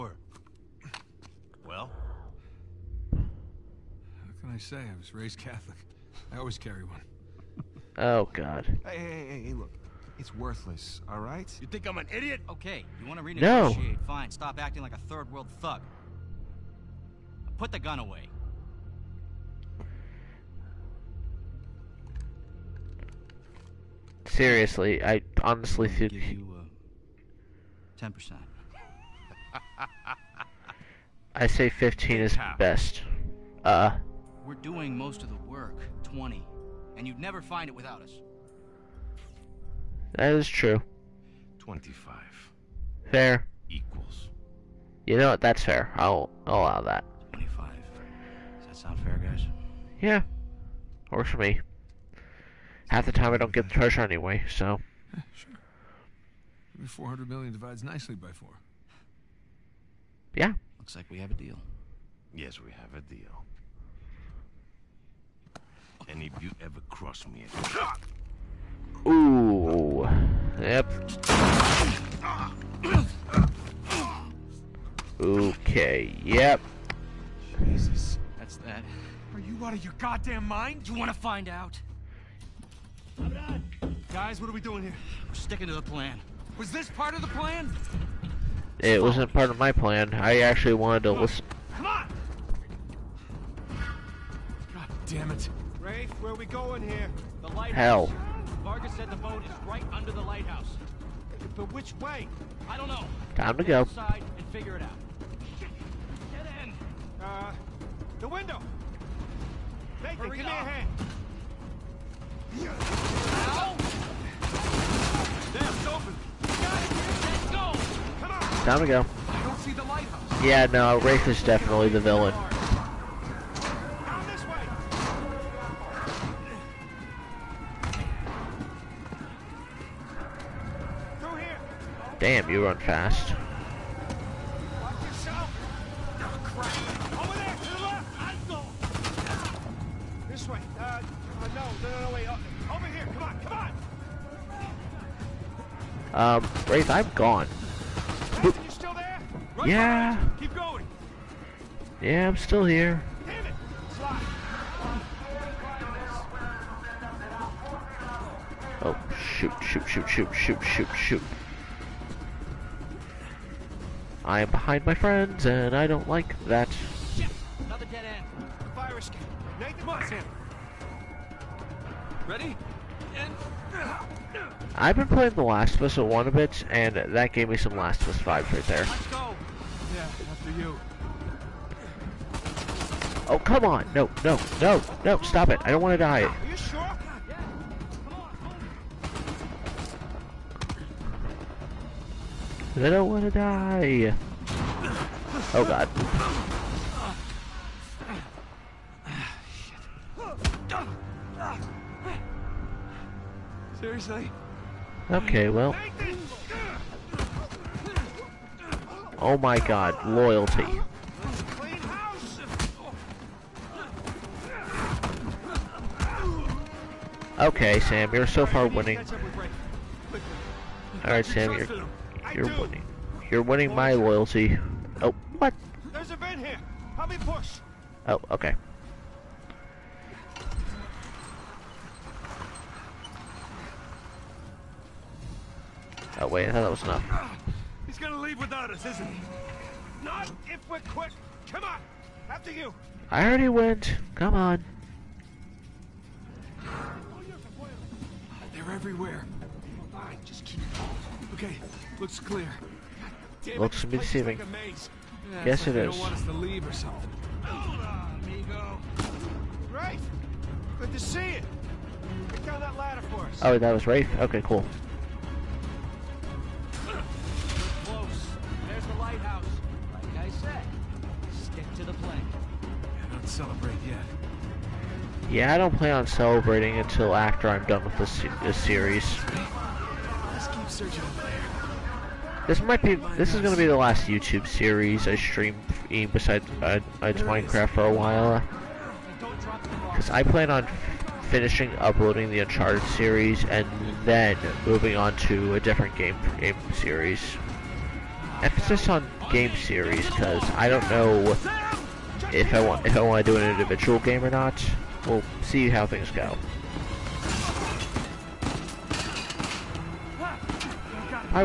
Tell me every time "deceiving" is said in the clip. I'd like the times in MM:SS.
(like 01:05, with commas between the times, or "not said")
04:13.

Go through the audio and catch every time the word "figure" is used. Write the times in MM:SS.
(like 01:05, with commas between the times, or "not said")
01:44.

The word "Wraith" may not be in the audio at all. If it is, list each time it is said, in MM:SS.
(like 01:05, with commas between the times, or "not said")
02:26.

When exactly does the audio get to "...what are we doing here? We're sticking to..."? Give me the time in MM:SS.
01:24.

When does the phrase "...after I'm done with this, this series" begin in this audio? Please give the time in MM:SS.
04:37.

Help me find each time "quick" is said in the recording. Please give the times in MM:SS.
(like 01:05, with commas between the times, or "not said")
04:00.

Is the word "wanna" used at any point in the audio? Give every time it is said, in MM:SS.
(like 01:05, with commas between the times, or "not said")
01:20.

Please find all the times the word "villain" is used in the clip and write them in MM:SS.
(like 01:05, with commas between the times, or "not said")
02:01.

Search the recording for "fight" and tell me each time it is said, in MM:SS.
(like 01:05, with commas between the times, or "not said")
not said.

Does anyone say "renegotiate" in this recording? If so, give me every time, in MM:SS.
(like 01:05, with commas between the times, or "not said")
00:13.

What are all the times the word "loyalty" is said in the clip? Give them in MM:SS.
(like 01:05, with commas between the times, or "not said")
03:30, 03:43.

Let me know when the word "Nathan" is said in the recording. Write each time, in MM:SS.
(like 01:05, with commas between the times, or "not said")
01:50, 02:49.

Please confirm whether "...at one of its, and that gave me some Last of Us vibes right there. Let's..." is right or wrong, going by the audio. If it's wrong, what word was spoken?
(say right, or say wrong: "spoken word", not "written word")
right.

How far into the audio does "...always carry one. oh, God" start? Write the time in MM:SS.
00:06.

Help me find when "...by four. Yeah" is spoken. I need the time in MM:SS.
00:58.